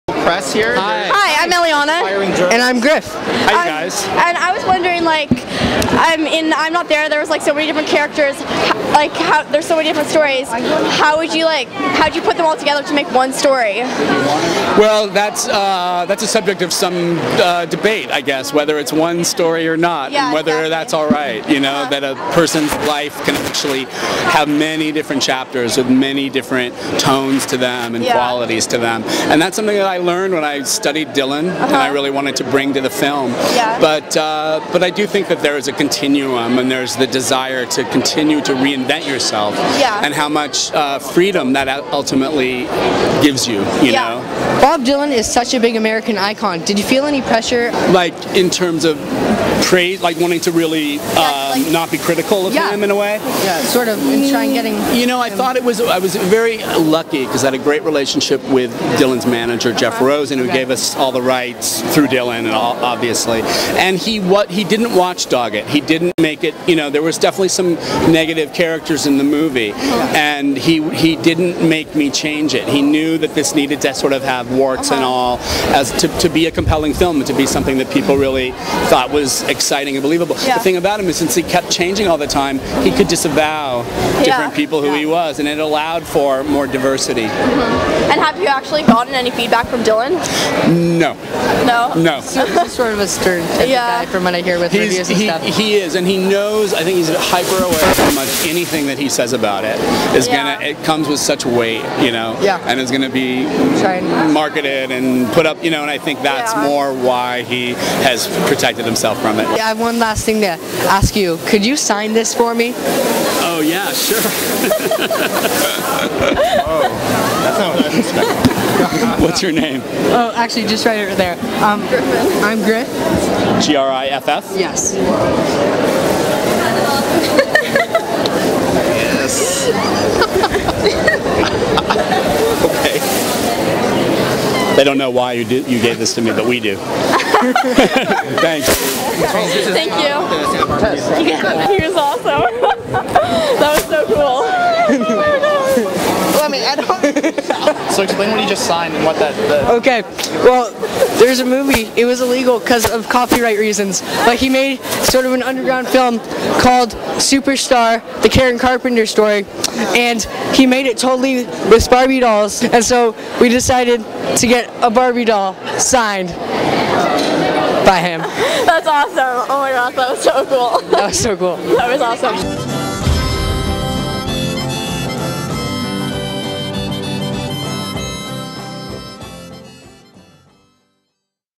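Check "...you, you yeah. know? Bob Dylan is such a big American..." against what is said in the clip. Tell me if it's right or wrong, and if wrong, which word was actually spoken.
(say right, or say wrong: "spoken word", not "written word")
right.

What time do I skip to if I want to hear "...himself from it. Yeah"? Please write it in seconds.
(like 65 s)
108 s.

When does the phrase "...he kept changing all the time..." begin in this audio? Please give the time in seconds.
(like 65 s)
81 s.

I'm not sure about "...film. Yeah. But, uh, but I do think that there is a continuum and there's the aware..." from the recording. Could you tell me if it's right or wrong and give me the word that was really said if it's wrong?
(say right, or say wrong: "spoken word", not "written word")
wrong: "desire", not "aware".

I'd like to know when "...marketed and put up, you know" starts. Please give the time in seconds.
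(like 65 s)
104 s.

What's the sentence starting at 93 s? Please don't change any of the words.
guy from what I hear with he's, reviews and he, stuff.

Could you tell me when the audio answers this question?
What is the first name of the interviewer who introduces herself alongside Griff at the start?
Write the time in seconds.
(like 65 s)
1 s.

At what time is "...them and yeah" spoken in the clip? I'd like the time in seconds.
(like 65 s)
27 s.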